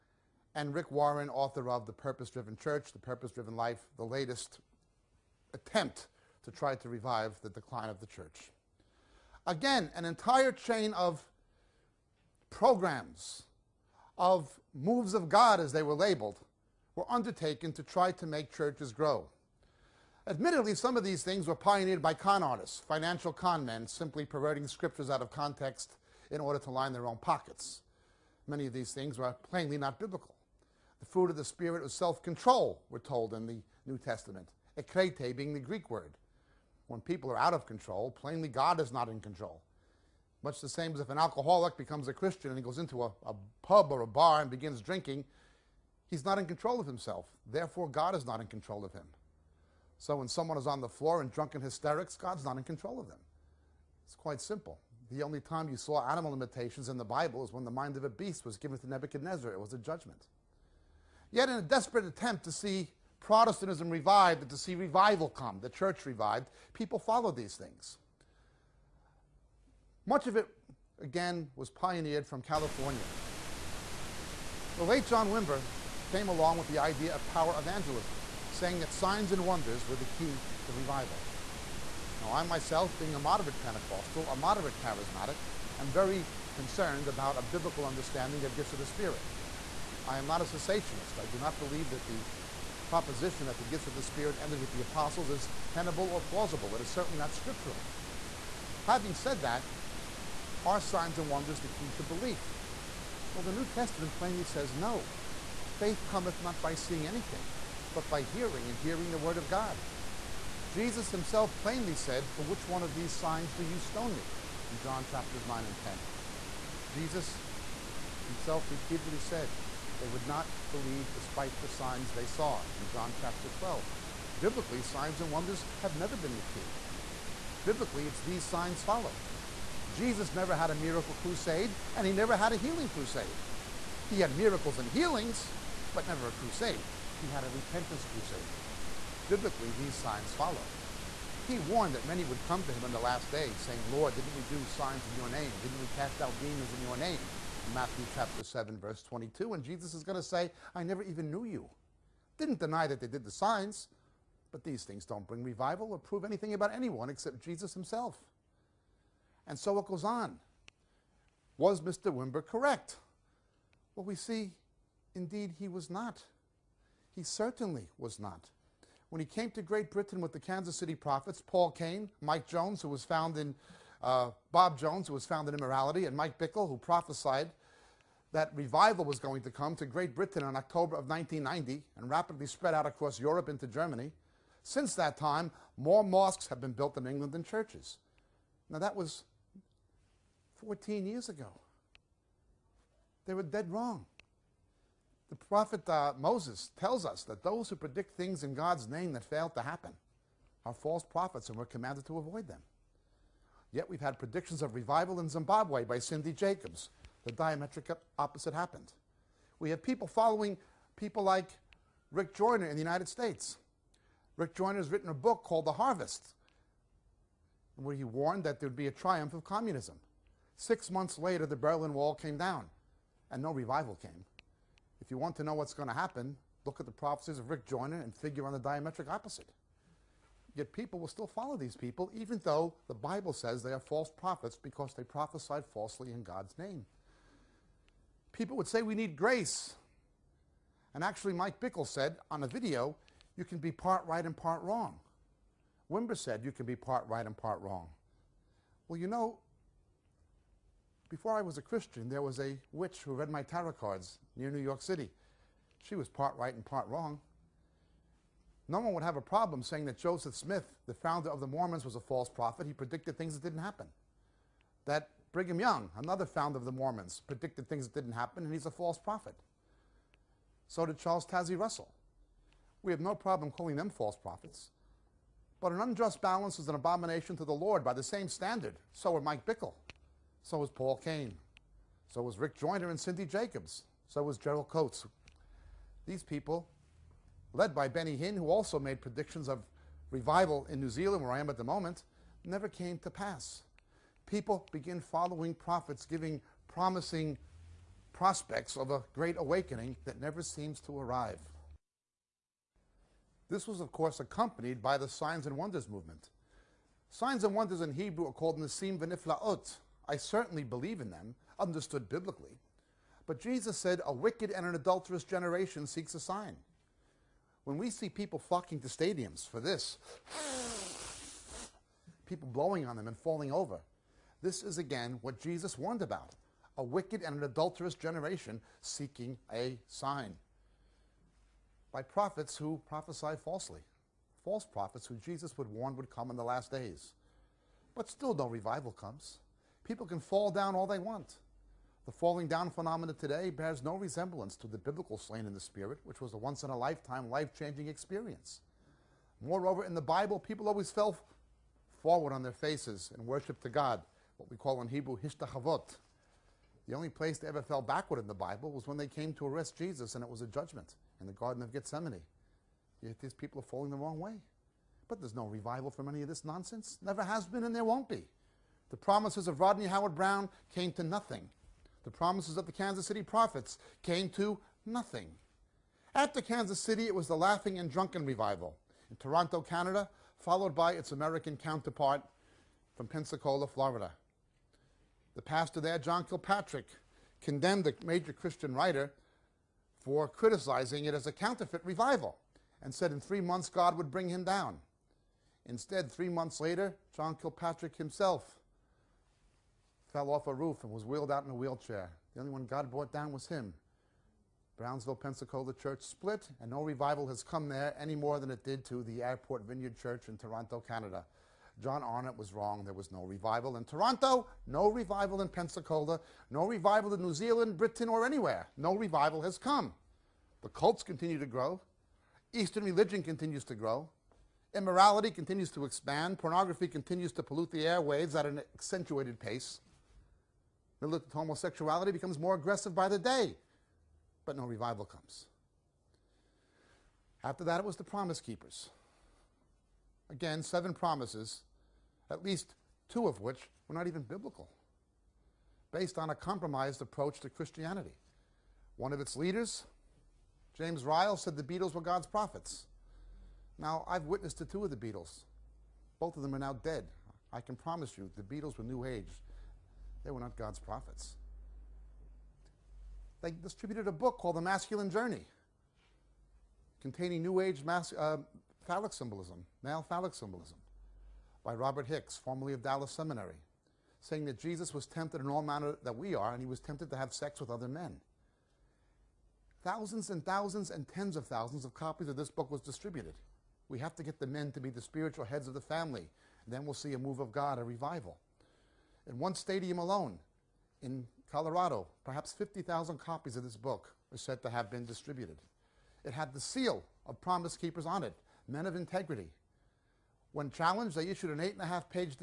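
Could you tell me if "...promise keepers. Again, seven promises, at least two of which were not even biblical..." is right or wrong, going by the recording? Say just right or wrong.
right.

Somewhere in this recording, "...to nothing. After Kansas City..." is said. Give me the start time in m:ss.
6:14.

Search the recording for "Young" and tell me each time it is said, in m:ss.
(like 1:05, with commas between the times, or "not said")
4:25.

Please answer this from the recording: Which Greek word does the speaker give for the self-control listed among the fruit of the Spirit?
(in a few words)
ekrete.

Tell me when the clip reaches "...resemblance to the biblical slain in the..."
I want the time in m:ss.
5:43.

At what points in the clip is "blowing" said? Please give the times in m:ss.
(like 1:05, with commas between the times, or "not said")
5:22.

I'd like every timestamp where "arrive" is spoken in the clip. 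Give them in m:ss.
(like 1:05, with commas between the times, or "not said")
5:00.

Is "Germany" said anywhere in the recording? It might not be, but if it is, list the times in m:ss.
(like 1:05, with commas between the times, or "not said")
3:03.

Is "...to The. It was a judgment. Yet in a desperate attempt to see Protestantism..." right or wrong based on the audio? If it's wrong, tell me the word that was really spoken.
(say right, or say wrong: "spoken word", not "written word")
wrong: "Nebuchadnezzar", not "The".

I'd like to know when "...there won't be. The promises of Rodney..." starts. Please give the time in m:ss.
6:07.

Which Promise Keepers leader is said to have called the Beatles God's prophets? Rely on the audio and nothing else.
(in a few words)
James Ryle.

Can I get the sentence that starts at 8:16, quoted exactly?
It had the seal of Promise Keepers on it, men of integrity.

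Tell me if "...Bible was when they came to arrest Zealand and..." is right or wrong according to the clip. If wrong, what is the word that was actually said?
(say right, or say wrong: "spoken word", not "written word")
wrong: "Jesus", not "Zealand".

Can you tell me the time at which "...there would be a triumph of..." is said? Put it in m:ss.
3:38.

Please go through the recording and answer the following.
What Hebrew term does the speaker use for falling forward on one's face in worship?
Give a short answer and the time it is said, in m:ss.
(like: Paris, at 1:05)
hishtachavot, at 5:55.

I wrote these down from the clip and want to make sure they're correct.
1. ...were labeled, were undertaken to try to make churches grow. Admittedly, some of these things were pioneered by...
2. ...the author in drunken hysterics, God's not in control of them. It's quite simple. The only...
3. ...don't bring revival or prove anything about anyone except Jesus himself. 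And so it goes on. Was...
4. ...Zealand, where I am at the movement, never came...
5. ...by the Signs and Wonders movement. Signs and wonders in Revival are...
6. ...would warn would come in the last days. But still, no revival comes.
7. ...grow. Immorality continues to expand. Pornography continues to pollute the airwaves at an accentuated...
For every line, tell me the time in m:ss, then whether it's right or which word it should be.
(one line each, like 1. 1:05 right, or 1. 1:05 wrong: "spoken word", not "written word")
1. 0:15 right
2. 0:50 wrong: "floor", not "author"
3. 2:35 right
4. 4:50 wrong: "moment", not "movement"
5. 5:04 wrong: "Hebrew", not "Revival"
6. 5:35 right
7. 7:03 right.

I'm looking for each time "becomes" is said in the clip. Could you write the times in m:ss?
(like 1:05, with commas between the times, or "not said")
0:41, 7:12.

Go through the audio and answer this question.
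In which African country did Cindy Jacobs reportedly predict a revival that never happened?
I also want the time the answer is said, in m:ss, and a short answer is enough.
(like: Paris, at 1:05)
Zimbabwe, at 3:25.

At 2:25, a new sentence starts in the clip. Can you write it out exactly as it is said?
Didn't we cast out demons in your name?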